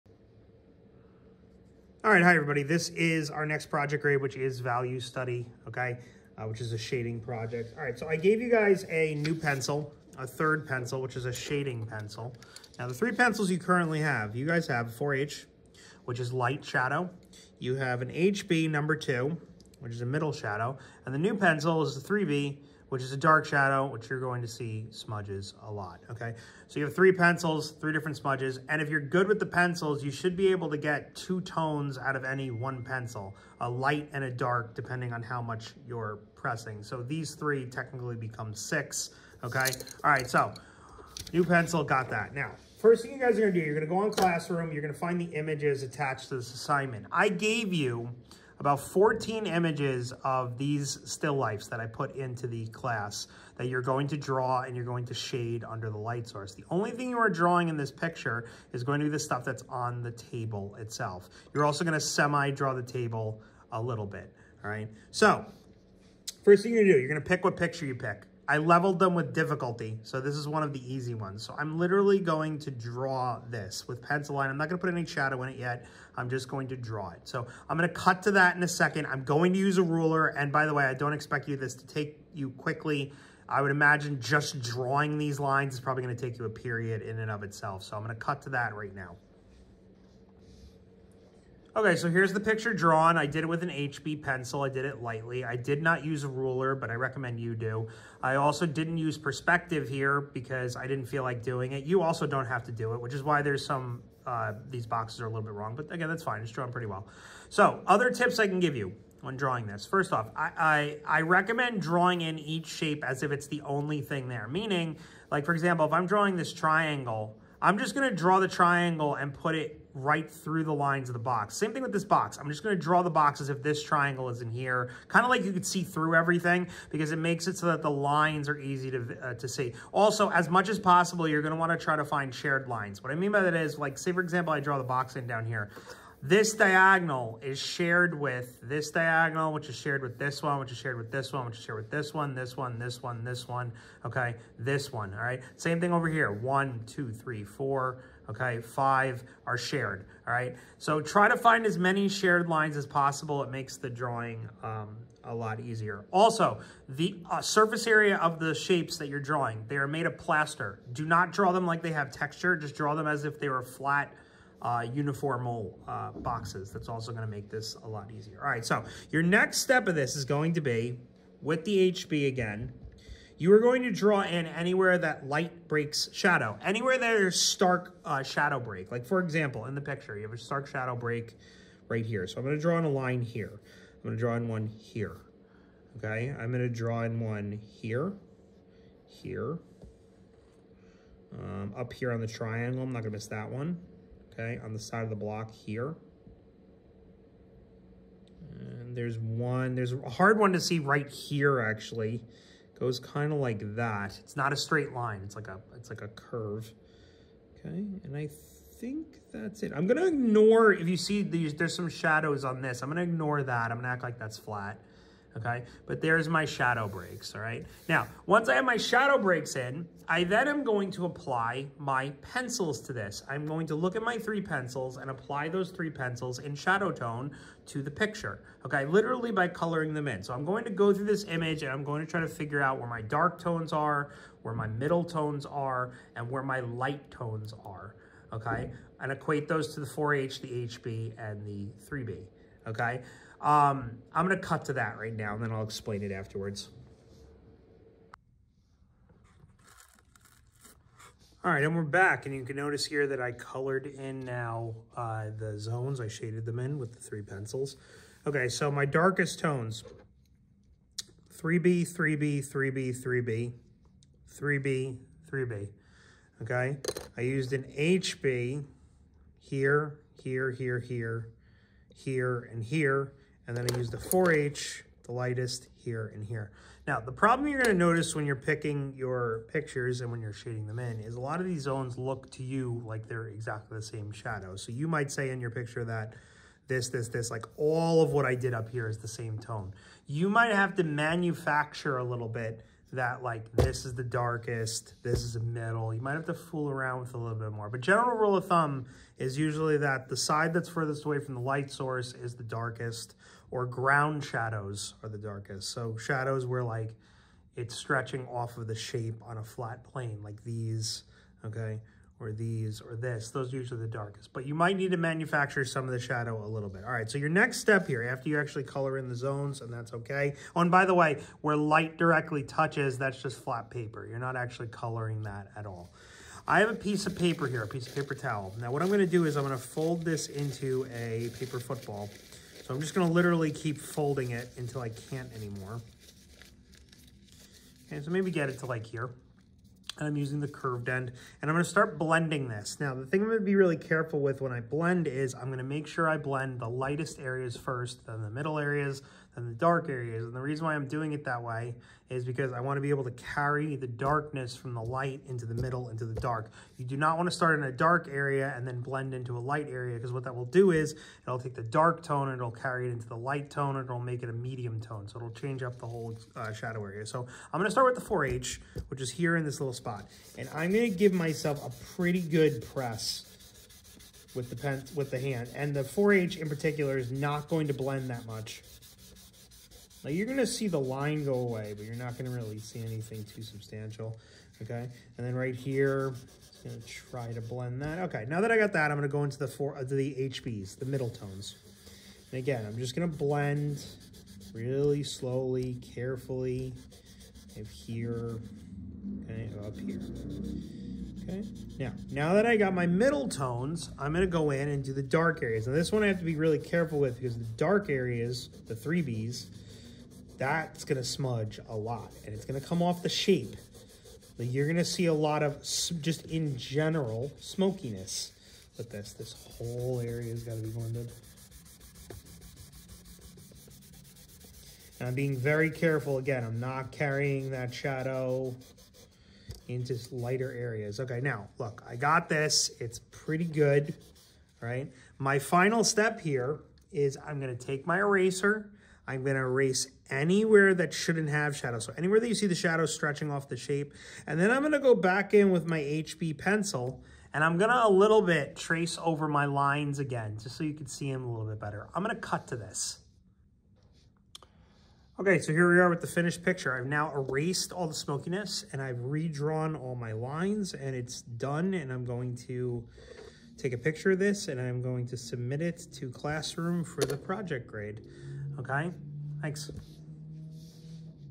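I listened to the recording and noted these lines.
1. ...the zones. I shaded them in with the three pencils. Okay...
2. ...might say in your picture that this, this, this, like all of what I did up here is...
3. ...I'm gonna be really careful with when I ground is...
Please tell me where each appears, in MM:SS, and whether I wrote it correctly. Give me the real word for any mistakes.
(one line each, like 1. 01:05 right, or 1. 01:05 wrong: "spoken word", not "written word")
1. 04:15 right
2. 04:44 right
3. 05:43 wrong: "blend", not "ground".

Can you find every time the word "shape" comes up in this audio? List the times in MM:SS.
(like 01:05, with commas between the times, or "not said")
01:52, 02:38, 05:08, 06:53, 07:23.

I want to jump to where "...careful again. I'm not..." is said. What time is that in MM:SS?
07:05.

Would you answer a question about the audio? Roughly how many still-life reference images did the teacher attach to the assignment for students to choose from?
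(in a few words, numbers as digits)
14.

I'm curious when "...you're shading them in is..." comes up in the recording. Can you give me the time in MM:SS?
04:40.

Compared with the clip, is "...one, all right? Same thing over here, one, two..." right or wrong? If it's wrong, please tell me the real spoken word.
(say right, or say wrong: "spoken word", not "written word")
right.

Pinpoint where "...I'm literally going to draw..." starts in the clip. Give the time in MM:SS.
01:11.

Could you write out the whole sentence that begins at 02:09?
Also, as much as possible, you're going to want to try to find shared lines.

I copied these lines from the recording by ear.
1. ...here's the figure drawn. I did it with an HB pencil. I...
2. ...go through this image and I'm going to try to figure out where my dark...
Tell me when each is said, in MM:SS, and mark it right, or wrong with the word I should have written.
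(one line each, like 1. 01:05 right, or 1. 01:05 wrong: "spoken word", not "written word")
1. 01:32 wrong: "picture", not "figure"
2. 03:50 right.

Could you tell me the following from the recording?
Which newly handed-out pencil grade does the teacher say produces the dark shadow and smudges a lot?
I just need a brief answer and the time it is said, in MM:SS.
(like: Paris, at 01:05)
3B, at 00:21.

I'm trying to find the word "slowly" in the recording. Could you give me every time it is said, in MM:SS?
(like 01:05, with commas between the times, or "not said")
06:35.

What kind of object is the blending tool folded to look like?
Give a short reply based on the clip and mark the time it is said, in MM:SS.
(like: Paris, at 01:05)
A paper football, at 05:31.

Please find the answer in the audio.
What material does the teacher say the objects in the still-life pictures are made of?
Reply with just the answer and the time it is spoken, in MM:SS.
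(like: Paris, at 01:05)
Plaster, at 02:39.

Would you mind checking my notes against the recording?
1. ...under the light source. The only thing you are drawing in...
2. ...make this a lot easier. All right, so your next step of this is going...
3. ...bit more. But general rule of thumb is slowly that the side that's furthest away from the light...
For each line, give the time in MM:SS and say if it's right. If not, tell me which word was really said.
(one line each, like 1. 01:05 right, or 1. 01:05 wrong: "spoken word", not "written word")
1. 00:55 right
2. 02:47 right
3. 04:57 wrong: "usually", not "slowly".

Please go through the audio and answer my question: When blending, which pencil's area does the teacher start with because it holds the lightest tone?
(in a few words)
4H.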